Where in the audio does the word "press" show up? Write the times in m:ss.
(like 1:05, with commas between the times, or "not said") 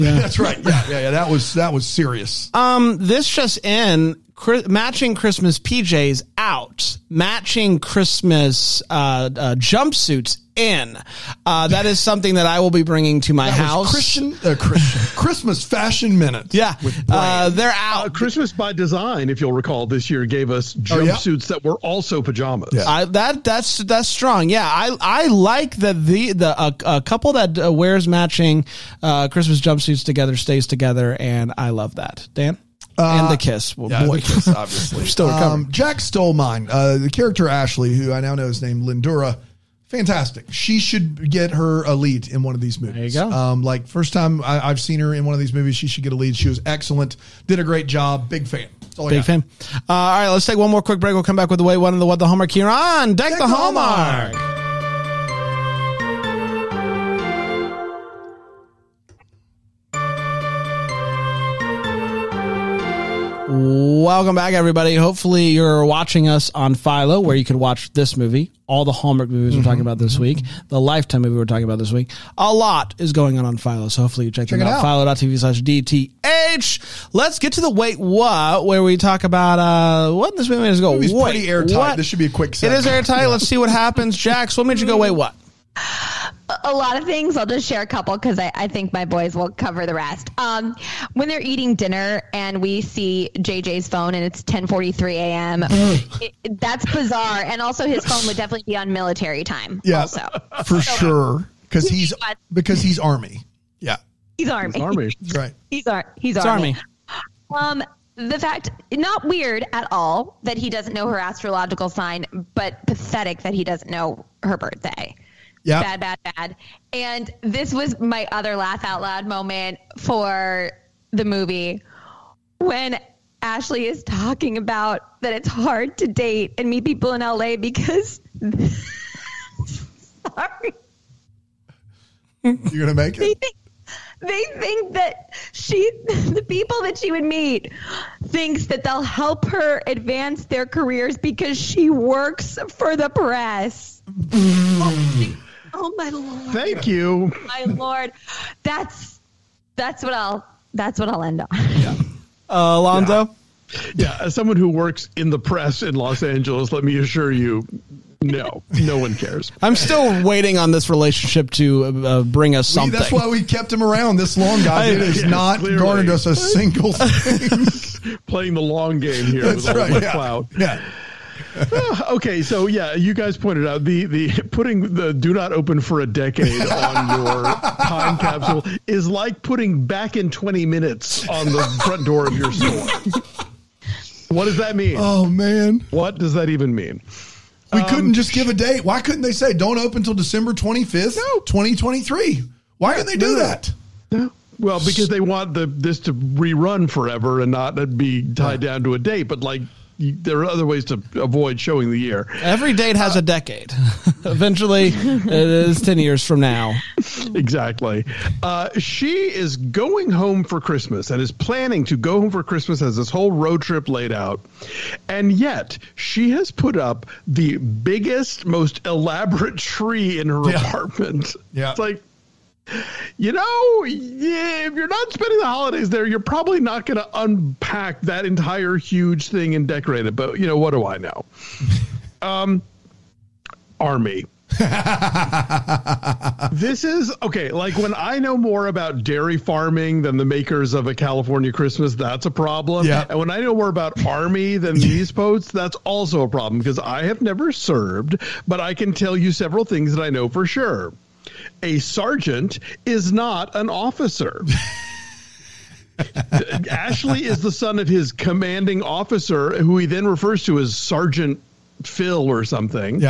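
2:23, 2:35.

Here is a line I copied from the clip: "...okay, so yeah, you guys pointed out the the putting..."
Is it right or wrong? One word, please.
right.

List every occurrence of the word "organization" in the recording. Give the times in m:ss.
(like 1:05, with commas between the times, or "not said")
not said.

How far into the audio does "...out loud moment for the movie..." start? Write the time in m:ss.
1:58.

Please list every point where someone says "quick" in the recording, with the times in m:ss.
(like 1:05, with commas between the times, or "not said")
0:50, 1:22.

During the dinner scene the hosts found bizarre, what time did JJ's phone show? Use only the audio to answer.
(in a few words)
10:43 a.m.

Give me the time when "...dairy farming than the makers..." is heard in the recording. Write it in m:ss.
3:59.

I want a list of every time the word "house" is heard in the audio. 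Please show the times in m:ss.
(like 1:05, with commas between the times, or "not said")
0:13.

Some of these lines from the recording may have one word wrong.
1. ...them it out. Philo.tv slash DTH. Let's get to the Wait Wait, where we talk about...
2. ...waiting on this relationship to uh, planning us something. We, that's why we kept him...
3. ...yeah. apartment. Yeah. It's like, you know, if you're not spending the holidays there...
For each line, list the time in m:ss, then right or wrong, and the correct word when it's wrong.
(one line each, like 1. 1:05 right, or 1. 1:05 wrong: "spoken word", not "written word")
1. 1:14 wrong: "What", not "Wait"
2. 2:40 wrong: "bring", not "planning"
3. 3:40 right.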